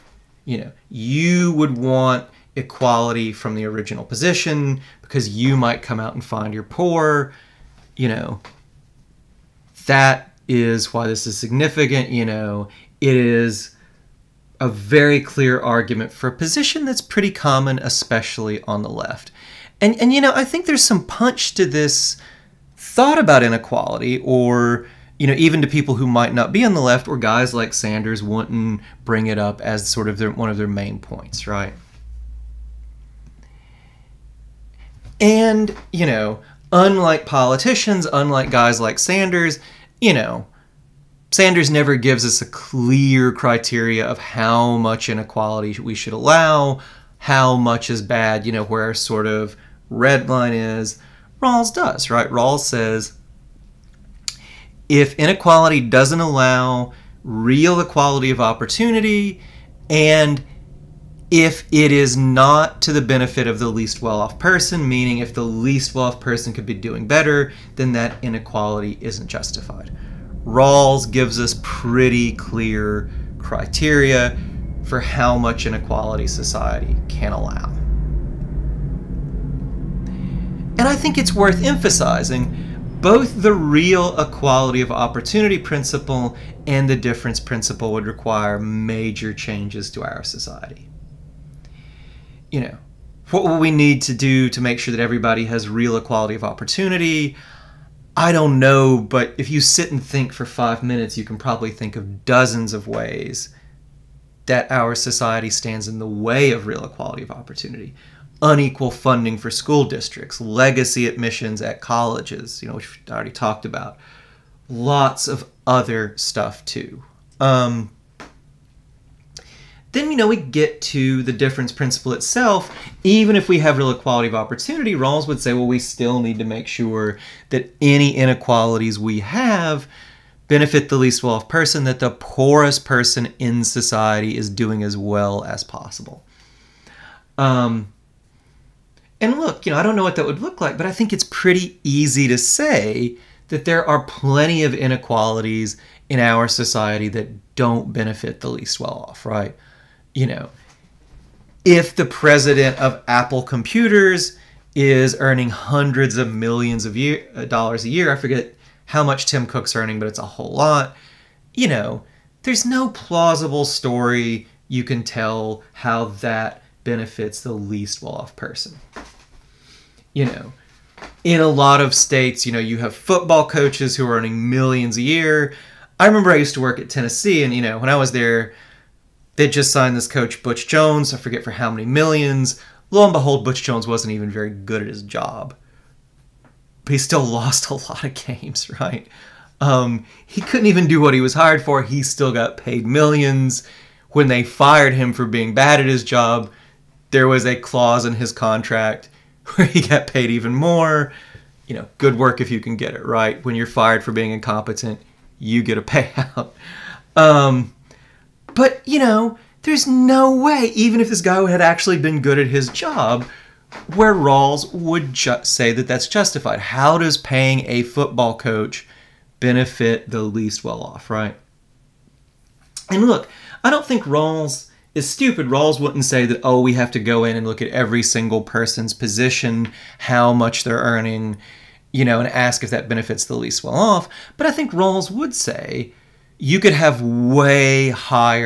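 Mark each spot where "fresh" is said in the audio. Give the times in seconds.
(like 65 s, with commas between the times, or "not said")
not said.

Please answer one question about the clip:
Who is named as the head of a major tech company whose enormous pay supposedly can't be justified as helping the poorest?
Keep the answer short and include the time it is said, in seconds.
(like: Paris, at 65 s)
Tim Cook, at 159 s.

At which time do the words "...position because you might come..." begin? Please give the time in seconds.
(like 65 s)
4 s.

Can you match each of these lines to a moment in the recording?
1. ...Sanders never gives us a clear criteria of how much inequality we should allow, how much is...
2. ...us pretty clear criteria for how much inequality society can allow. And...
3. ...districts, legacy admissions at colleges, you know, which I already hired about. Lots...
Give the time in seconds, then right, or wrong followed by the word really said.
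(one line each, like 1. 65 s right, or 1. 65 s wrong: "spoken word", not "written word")
1. 41 s right
2. 71 s right
3. 109 s wrong: "talked", not "hired".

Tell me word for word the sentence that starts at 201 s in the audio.
You know, good work if you can get it right.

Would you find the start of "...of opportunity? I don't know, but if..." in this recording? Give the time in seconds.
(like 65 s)
96 s.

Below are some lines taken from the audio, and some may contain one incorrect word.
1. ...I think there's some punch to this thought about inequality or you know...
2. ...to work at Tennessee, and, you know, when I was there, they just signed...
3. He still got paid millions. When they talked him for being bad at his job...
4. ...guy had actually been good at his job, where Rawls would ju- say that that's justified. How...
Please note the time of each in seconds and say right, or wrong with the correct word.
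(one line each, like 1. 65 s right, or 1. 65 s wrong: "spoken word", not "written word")
1. 20 s right
2. 176 s right
3. 191 s wrong: "fired", not "talked"
4. 211 s right.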